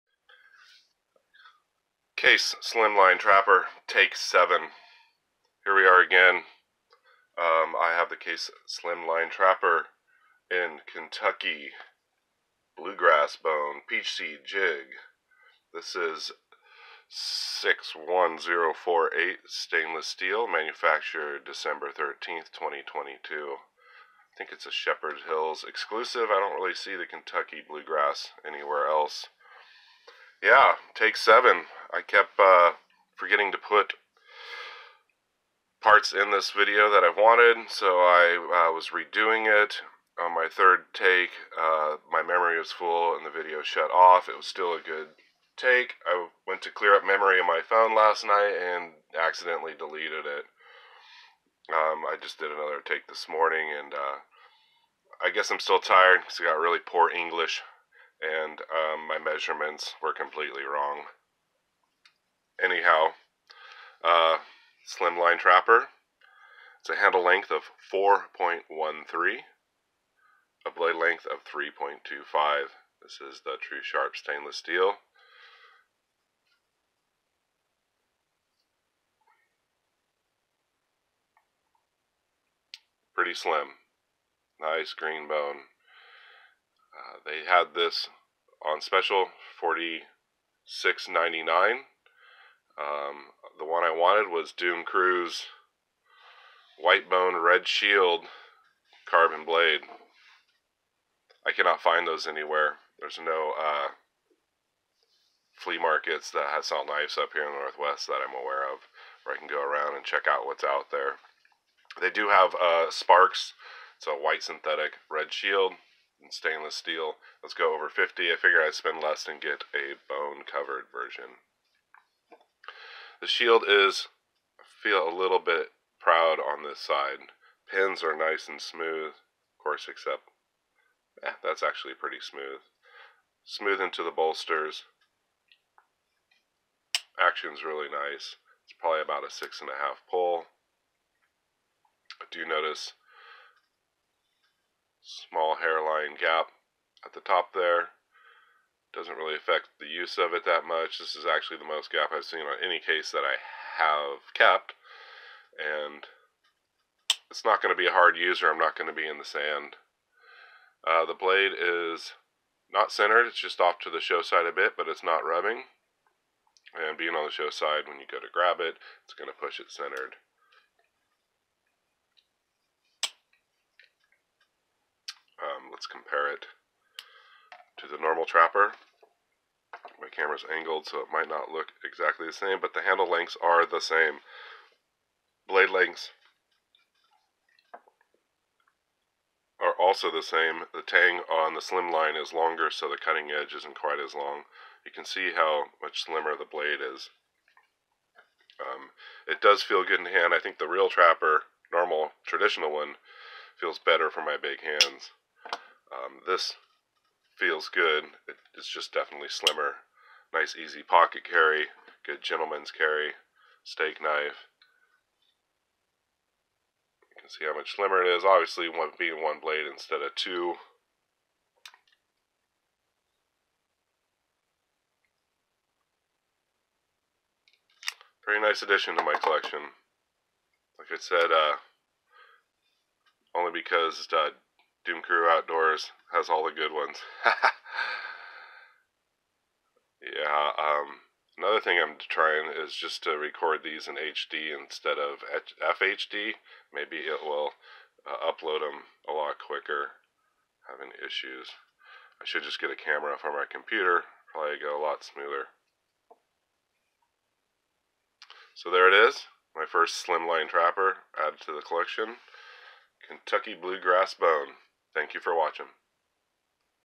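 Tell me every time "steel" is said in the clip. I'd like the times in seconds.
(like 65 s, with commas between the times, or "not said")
20 s, 74 s, 116 s.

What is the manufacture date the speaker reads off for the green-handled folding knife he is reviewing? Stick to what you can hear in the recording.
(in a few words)
December 13th, 2022.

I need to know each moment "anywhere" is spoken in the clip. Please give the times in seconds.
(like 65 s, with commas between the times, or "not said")
28 s, 102 s.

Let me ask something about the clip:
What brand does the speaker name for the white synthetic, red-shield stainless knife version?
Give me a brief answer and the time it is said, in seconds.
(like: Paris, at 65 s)
Sparxx, at 112 s.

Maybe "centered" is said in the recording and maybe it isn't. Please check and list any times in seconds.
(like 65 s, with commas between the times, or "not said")
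162 s, 169 s.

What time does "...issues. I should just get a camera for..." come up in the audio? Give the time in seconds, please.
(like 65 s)
251 s.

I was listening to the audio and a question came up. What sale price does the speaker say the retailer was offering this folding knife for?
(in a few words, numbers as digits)
46.99.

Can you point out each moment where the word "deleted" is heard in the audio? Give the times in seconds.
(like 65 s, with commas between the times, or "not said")
49 s.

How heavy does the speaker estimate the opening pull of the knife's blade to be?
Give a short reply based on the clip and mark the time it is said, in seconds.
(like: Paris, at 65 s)
6.5, at 139 s.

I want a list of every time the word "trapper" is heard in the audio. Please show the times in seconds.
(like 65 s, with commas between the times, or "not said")
3 s, 9 s, 65 s, 178 s, 200 s, 260 s.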